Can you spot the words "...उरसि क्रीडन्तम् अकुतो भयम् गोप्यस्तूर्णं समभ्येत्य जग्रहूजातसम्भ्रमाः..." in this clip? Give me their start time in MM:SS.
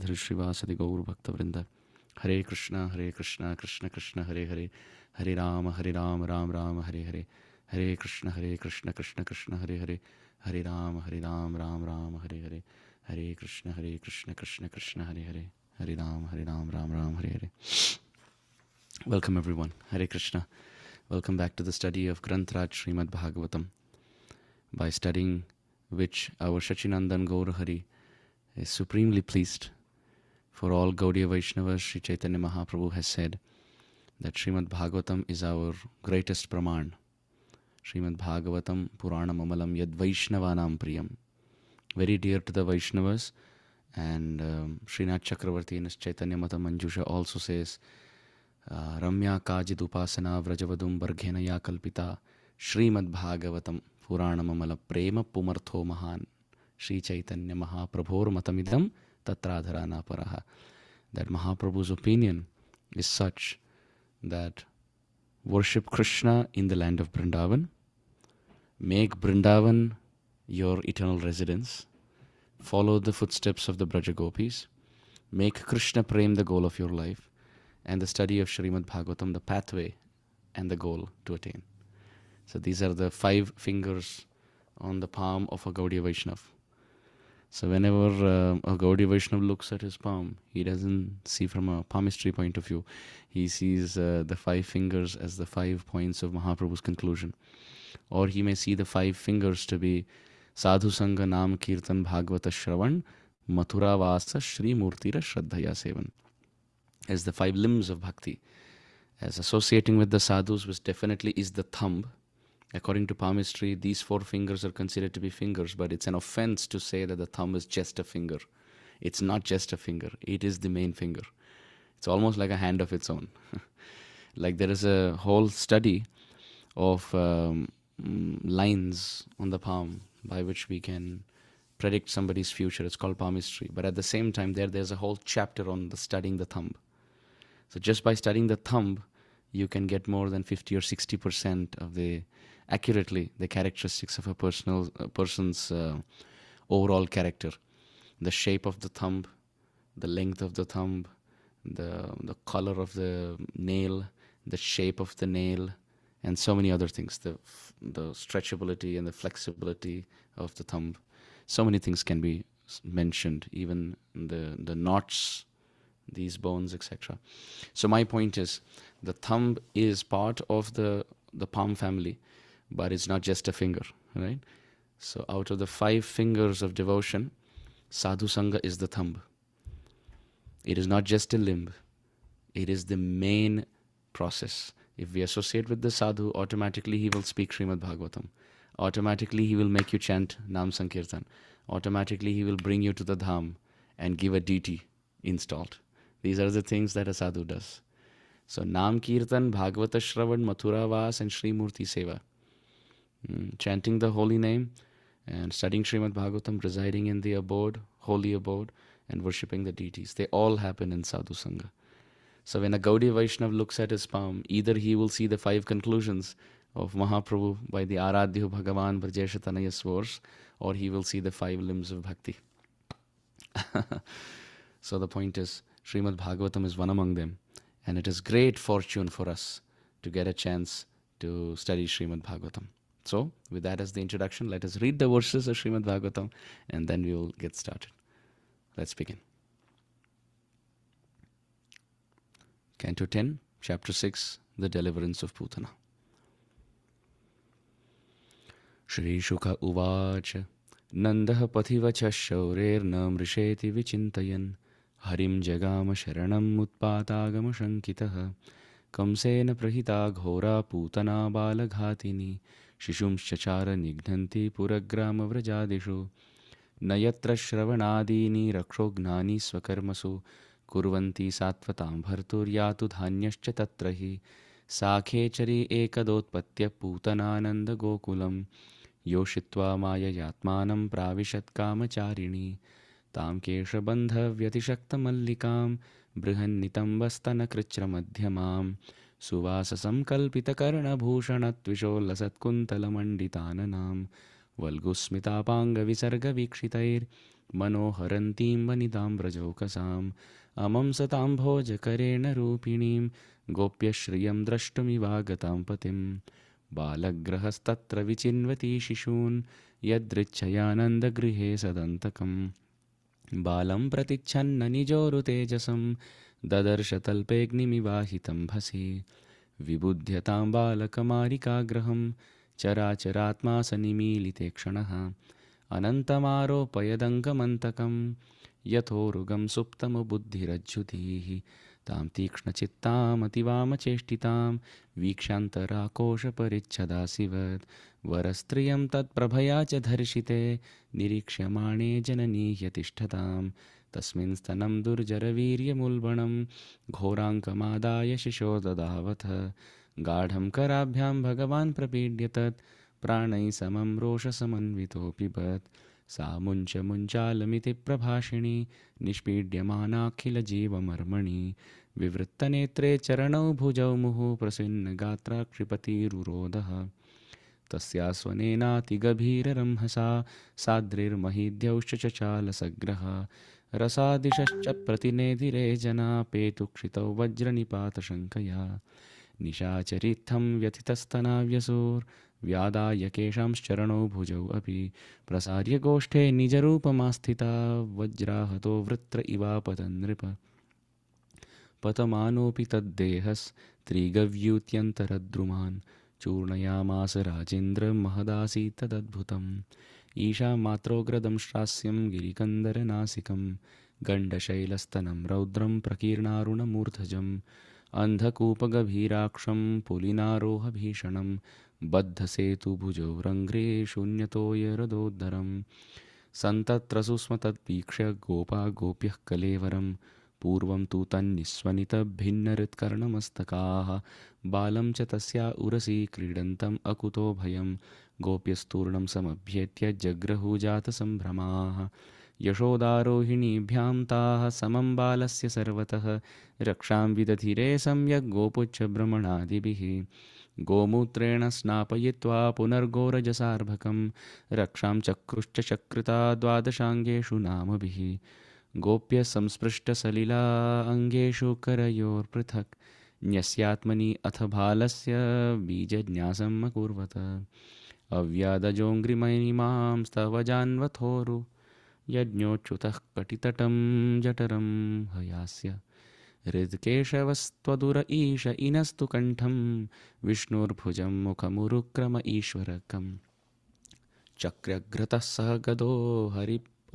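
07:05.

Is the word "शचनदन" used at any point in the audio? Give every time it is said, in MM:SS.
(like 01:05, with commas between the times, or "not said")
00:26.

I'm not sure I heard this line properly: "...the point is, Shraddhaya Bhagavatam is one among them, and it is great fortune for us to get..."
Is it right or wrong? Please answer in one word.
wrong.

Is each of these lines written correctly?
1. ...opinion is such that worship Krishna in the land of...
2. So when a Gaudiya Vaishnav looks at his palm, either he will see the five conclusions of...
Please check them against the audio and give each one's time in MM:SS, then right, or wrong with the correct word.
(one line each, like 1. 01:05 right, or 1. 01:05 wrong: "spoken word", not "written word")
1. 01:01 right
2. 03:32 right.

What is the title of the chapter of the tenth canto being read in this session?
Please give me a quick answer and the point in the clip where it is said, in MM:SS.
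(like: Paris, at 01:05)
The Deliverance of Putana, at 04:04.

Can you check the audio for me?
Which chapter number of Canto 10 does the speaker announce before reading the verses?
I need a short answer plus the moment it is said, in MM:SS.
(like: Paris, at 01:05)
6, at 04:03.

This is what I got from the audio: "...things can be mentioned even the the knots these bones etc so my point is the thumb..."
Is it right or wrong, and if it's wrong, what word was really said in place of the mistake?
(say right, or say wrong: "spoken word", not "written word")
right.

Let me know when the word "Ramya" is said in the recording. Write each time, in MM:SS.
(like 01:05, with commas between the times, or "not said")
00:48.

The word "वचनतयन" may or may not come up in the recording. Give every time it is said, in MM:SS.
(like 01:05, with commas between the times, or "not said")
04:13.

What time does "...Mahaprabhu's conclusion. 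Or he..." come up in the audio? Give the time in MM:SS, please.
01:36.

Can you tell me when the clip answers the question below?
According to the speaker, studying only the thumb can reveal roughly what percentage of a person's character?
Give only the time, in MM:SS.
02:20.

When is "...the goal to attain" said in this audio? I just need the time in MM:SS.
01:20.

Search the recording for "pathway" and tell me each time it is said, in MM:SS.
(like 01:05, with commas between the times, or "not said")
01:19.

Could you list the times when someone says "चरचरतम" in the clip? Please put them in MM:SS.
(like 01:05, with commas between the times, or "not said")
05:22.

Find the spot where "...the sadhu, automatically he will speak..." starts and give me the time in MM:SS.
03:05.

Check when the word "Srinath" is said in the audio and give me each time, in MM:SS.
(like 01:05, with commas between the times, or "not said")
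00:44.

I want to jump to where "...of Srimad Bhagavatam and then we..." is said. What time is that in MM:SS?
03:55.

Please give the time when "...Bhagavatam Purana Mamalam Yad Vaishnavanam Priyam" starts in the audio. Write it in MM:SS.
00:38.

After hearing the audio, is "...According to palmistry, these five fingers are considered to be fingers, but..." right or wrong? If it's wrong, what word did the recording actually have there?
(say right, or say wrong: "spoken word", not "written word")
wrong: "four", not "five".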